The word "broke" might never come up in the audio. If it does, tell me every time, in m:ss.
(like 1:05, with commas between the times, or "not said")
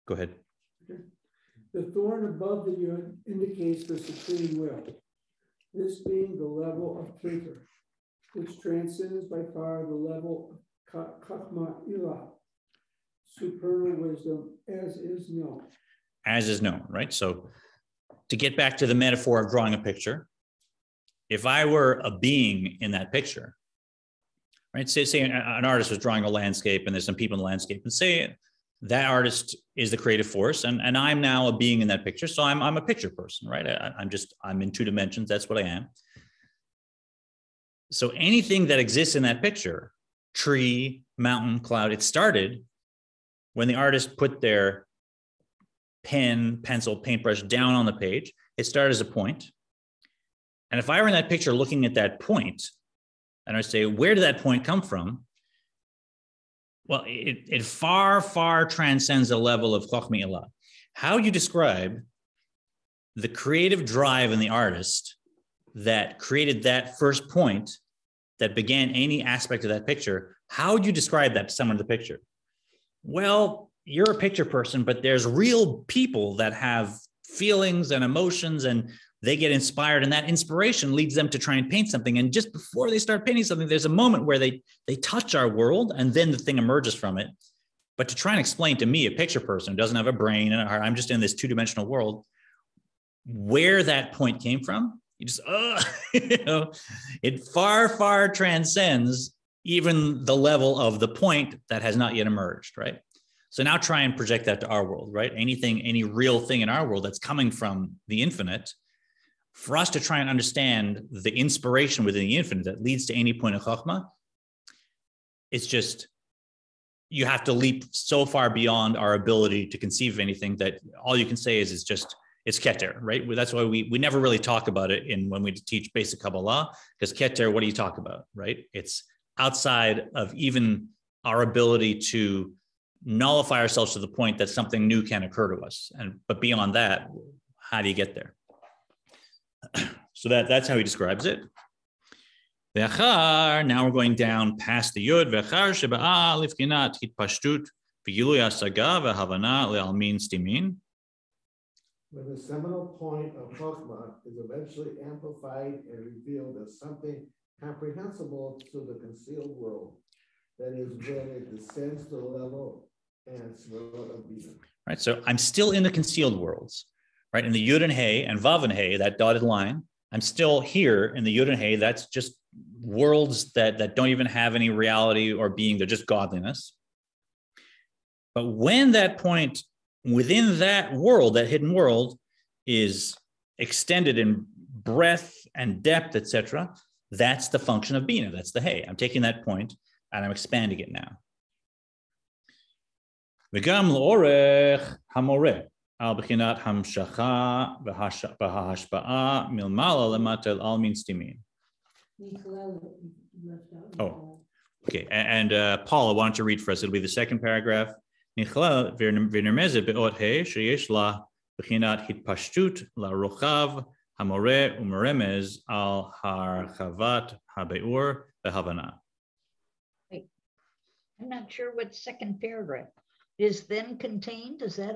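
not said.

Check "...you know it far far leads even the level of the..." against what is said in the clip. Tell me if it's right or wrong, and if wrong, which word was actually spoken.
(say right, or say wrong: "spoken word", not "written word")
wrong: "transcends", not "leads".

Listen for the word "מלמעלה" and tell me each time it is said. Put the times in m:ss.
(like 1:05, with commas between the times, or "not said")
3:19.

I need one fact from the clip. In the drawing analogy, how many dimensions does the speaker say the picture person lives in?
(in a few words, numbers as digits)
2.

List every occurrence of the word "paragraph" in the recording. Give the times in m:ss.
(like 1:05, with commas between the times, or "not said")
3:27, 3:42.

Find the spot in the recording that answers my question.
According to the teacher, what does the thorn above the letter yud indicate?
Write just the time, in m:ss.
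0:03.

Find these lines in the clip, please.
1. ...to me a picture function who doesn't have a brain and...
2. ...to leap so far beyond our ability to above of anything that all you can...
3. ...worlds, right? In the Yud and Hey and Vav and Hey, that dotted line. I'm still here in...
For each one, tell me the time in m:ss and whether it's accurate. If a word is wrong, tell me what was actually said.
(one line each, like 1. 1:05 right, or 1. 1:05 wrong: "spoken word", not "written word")
1. 1:28 wrong: "person", not "function"
2. 1:57 wrong: "conceive", not "above"
3. 2:46 right.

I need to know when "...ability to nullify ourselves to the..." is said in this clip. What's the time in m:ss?
2:11.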